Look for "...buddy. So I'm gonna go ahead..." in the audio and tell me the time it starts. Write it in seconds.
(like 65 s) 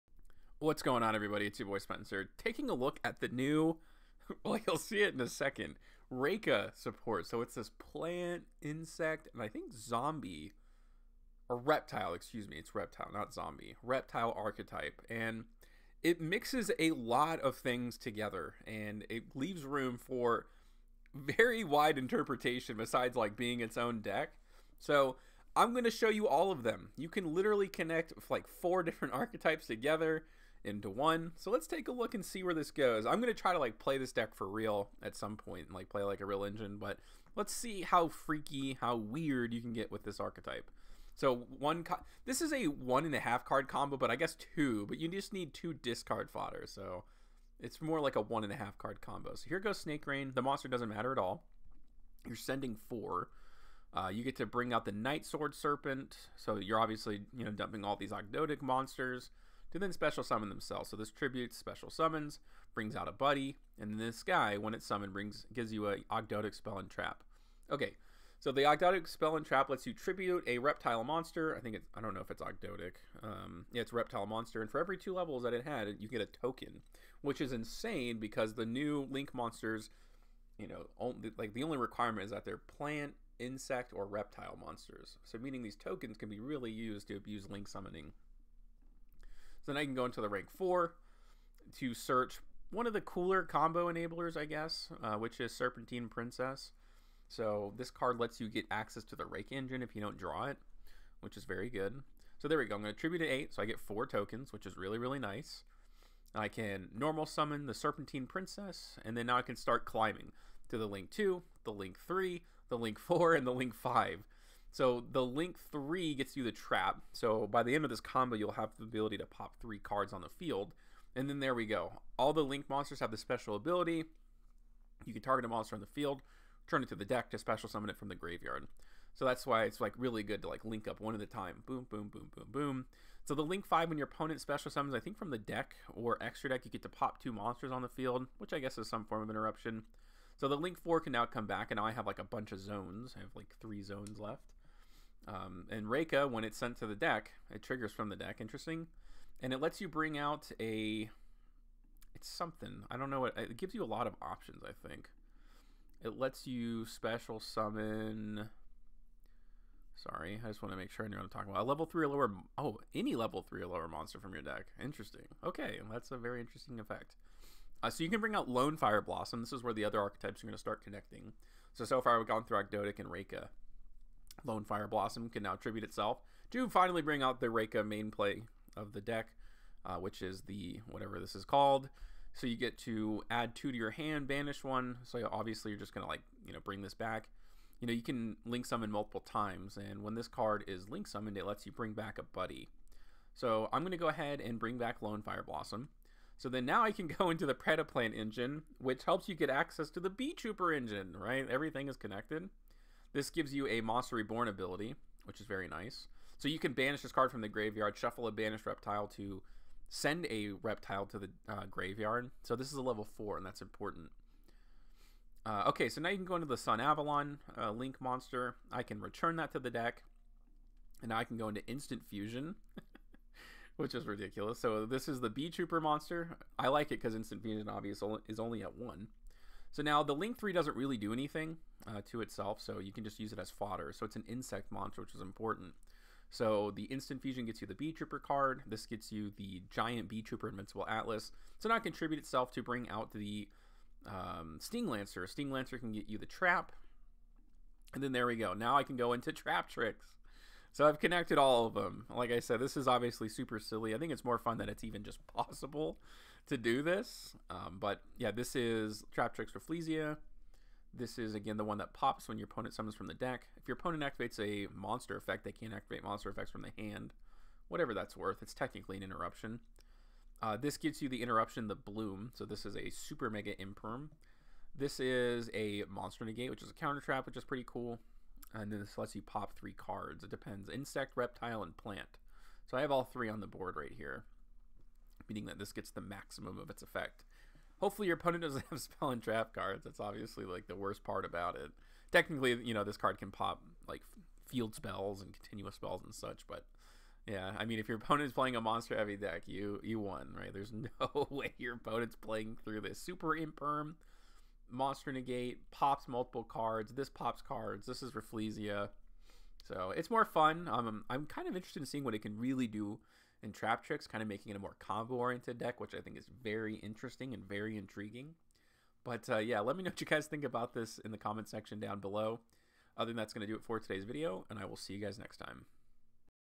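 192 s.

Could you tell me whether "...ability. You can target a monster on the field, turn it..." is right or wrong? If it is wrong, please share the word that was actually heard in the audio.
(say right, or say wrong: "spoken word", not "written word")
right.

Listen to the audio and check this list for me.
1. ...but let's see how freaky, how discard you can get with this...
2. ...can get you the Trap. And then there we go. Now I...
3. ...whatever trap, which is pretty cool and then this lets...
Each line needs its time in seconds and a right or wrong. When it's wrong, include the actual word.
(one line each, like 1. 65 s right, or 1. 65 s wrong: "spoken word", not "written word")
1. 36 s wrong: "weird", not "discard"
2. 245 s right
3. 276 s wrong: "counter", not "whatever".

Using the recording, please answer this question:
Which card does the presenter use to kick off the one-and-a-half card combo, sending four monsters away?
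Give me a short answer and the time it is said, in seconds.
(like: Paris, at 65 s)
Snake Rain, at 49 s.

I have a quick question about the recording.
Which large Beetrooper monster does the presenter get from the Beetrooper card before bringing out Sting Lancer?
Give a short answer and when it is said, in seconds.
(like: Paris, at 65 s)
Giant Beetrooper Invincible Atlas, at 239 s.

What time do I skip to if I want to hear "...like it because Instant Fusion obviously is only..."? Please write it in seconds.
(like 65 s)
226 s.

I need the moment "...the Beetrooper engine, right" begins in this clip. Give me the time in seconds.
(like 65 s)
199 s.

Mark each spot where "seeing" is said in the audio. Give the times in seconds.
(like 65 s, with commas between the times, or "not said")
311 s.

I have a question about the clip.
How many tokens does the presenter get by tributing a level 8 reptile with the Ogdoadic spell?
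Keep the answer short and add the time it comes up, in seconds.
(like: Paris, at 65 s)
4, at 103 s.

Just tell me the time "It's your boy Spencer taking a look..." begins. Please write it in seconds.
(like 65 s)
1 s.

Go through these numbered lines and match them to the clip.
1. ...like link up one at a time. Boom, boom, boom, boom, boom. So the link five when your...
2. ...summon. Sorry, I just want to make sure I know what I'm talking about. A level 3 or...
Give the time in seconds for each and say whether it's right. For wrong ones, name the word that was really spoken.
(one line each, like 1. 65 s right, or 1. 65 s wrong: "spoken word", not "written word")
1. 130 s right
2. 157 s right.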